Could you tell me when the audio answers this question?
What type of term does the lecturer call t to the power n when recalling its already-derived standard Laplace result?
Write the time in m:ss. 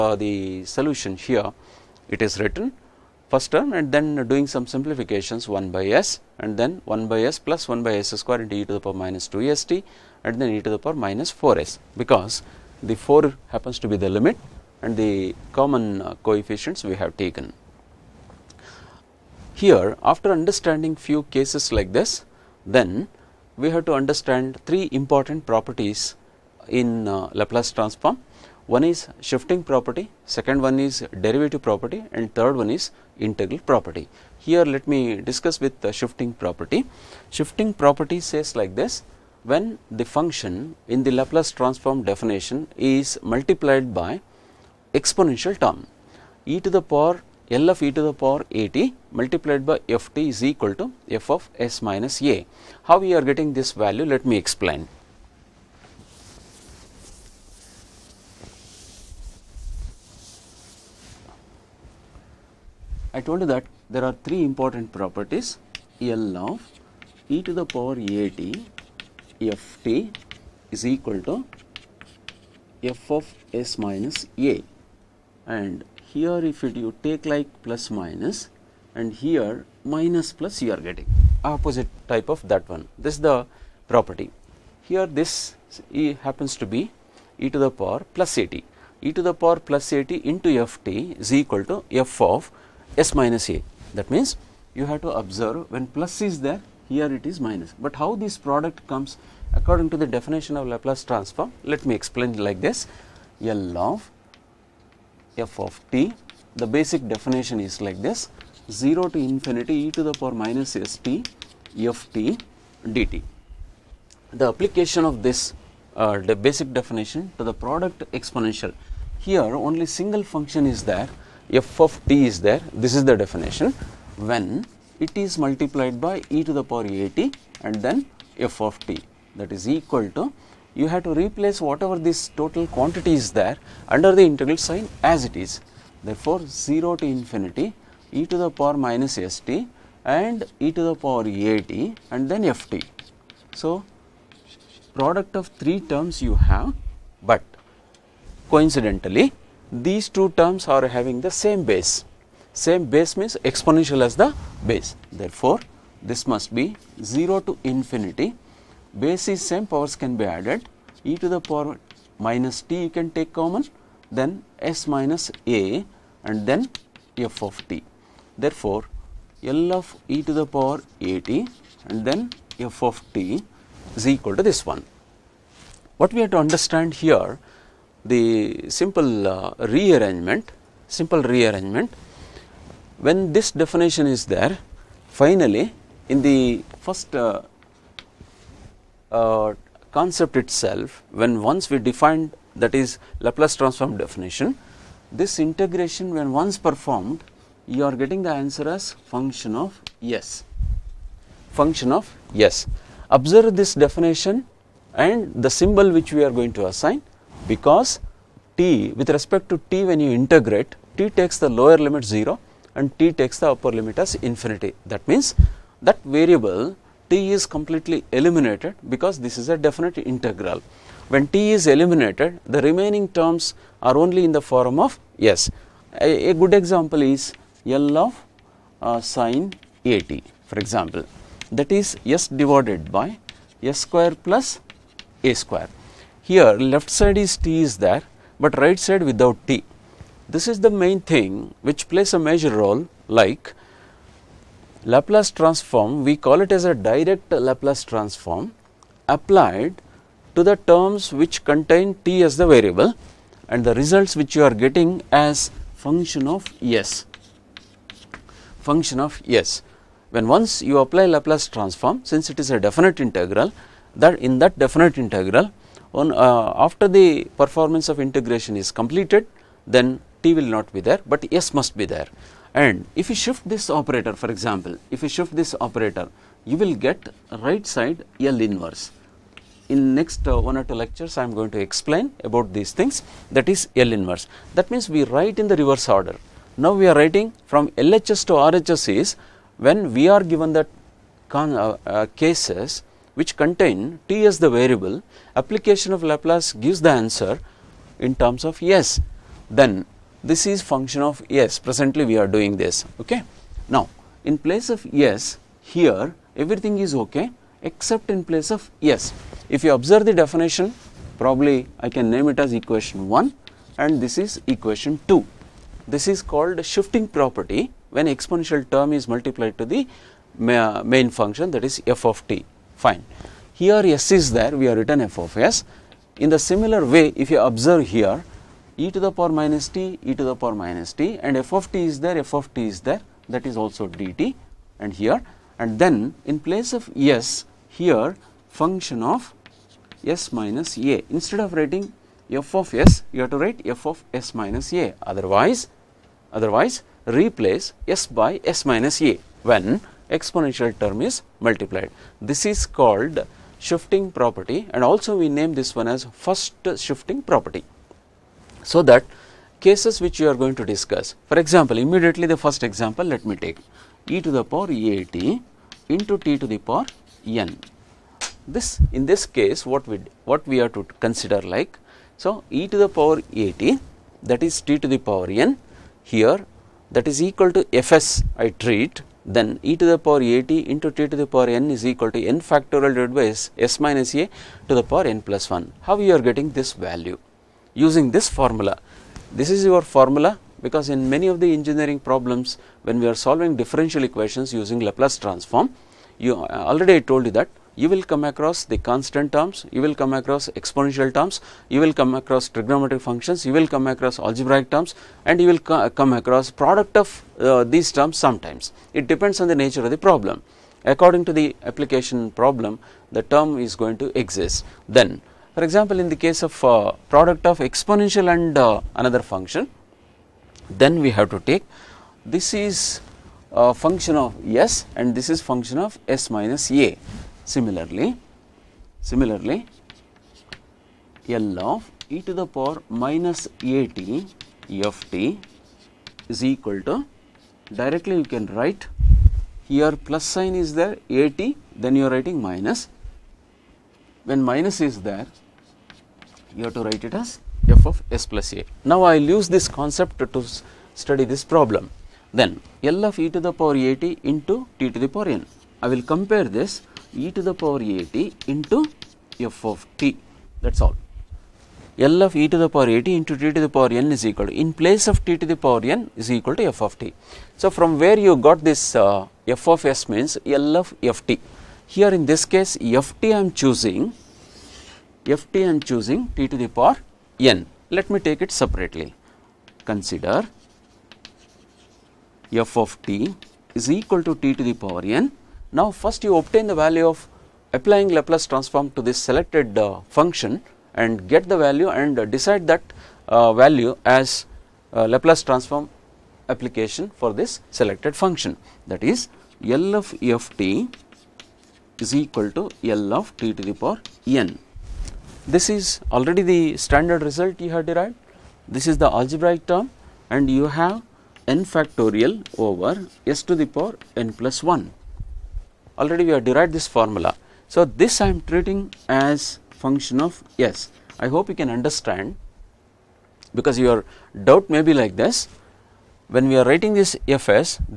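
8:29.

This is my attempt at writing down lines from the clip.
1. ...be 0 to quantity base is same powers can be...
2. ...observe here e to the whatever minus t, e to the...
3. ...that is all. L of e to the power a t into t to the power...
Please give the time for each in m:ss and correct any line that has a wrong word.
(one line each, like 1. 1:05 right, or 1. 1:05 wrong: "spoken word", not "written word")
1. 2:36 wrong: "infinity", not "quantity"
2. 5:27 wrong: "power", not "whatever"
3. 7:40 right.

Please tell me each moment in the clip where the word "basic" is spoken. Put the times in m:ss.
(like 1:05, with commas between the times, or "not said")
1:46, 1:56.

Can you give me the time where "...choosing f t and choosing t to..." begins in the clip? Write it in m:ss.
7:53.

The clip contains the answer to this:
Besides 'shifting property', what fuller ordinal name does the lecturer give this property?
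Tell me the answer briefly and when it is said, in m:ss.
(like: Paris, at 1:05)
First shifting property, at 5:56.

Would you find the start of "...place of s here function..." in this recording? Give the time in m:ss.
5:36.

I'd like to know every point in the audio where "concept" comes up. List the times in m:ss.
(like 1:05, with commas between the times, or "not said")
3:09, 7:29.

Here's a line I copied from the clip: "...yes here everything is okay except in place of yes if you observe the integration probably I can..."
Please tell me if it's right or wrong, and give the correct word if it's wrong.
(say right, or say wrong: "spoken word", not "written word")
wrong: "definition", not "integration".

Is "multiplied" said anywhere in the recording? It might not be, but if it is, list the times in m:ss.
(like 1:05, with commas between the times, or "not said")
0:43, 0:49, 2:05, 5:19, 5:51.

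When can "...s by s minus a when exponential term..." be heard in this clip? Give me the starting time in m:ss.
5:47.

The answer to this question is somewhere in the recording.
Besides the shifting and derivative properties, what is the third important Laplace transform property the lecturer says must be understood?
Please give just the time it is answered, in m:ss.
0:33.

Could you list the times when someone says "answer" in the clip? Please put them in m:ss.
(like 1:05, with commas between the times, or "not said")
3:18, 4:56.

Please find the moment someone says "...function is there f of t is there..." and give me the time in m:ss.
2:00.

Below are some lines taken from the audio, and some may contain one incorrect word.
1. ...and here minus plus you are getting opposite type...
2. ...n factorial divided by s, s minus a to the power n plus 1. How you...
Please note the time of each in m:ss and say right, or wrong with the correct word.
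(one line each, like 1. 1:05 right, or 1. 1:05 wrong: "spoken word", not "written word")
1. 1:18 right
2. 6:22 right.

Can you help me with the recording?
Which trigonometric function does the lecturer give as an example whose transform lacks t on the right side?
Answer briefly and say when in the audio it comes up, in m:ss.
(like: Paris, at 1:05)
Sine, at 3:49.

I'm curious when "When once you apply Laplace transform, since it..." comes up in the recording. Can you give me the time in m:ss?
4:20.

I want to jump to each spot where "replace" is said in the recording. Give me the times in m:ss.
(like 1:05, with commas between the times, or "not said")
2:11, 5:47.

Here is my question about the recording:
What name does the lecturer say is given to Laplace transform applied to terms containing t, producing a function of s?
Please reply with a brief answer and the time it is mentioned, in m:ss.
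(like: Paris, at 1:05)
Direct Laplace transform, at 4:06.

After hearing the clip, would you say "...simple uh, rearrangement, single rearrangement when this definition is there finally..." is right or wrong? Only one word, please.
wrong.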